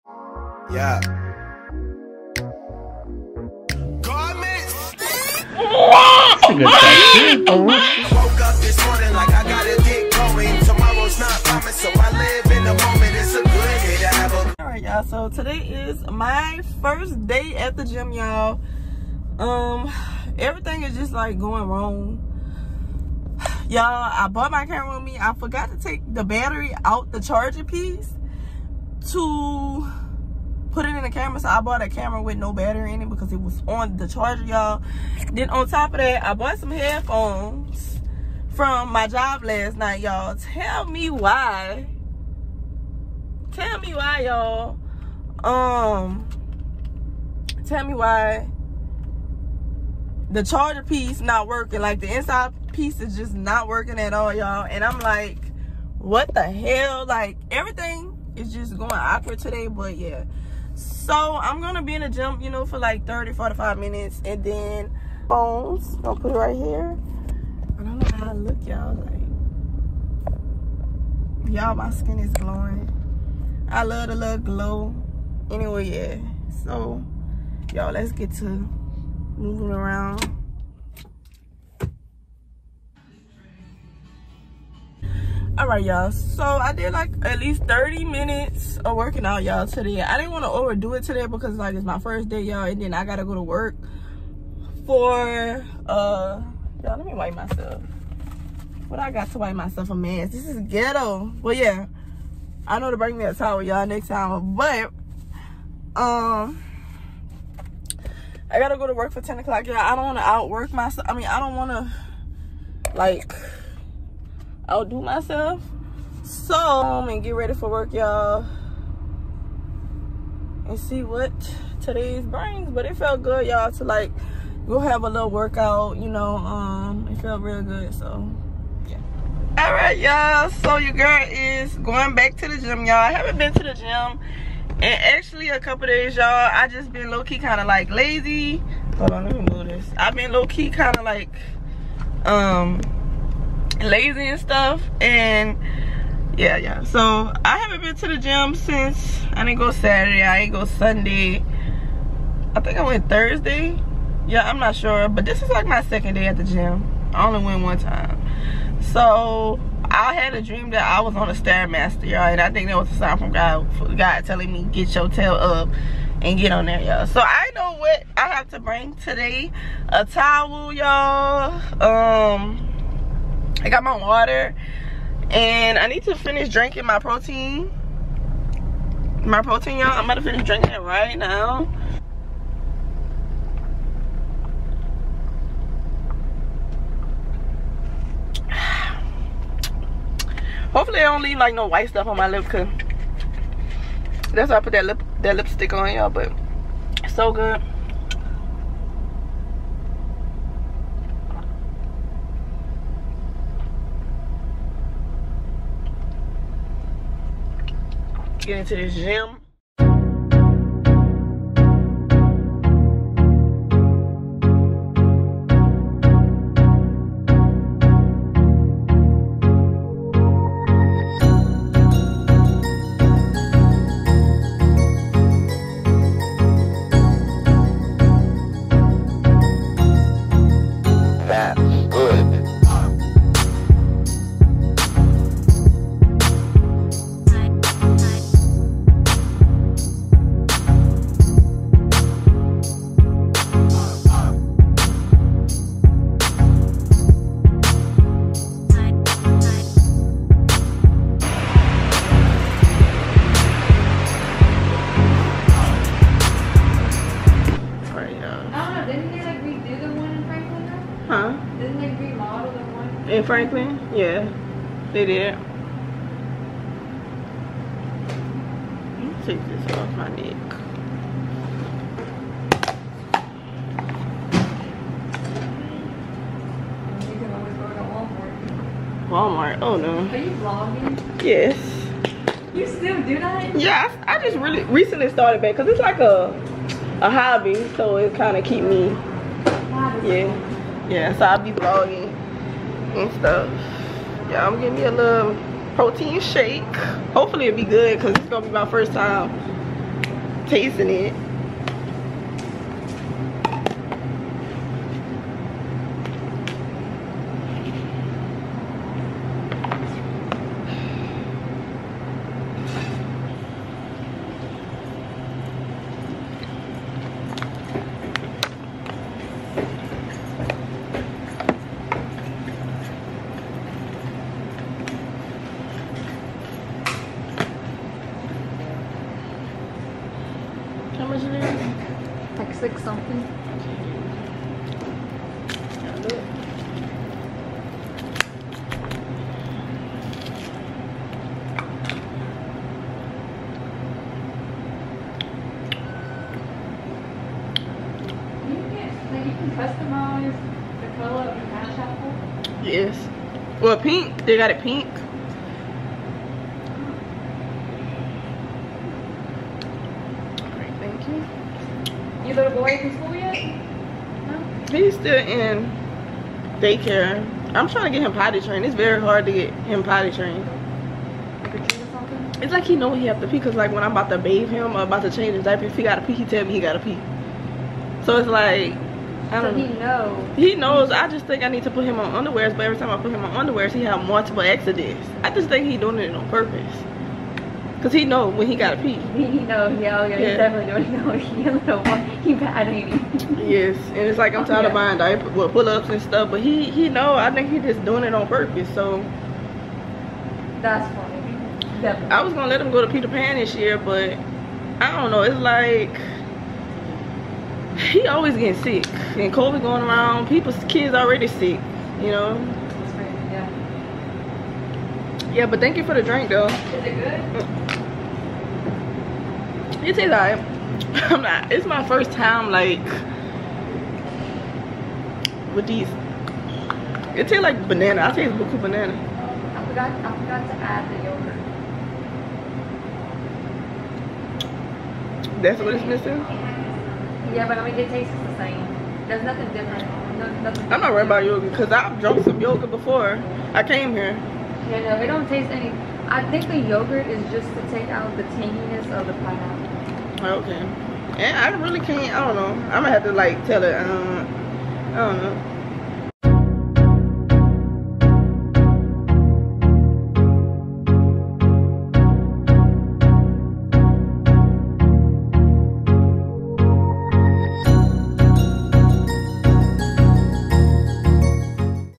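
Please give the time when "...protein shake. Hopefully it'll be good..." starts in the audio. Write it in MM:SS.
04:55.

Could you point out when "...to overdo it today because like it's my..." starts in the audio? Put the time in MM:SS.
01:30.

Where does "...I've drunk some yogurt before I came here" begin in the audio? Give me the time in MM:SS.
07:21.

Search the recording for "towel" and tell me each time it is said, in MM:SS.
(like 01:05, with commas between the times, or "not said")
01:43, 02:50.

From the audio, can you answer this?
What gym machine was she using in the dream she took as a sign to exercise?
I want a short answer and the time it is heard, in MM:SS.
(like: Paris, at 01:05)
Stairmaster, at 02:41.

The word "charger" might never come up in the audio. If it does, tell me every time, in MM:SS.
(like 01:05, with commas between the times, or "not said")
00:27, 00:34, 00:50.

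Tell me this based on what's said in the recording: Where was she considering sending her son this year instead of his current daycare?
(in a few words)
Peter Pan.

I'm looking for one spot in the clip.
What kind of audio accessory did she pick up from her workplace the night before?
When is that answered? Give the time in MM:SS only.
00:36.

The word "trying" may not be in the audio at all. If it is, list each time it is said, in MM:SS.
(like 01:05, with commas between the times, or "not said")
06:07.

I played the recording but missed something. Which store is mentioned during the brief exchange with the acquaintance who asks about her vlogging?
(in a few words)
Walmart.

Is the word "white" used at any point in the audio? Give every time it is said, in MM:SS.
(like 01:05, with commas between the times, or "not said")
03:11.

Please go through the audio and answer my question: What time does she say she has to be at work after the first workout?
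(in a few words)
10 o'clock.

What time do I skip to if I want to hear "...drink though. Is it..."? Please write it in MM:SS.
06:56.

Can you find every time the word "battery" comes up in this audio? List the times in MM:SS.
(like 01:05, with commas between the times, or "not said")
00:26, 00:32.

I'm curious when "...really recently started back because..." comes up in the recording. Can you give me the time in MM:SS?
04:44.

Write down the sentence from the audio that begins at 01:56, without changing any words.
So, um, and get ready for work, y'all.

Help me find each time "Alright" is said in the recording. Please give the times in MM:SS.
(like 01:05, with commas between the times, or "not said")
00:14, 02:09.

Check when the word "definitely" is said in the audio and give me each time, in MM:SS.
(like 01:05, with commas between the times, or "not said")
06:30, 06:41.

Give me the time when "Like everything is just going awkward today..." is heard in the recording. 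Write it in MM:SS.
00:57.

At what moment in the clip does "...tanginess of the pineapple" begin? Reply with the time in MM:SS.
07:28.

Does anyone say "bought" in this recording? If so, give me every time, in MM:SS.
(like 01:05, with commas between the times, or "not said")
00:24, 00:31, 00:36.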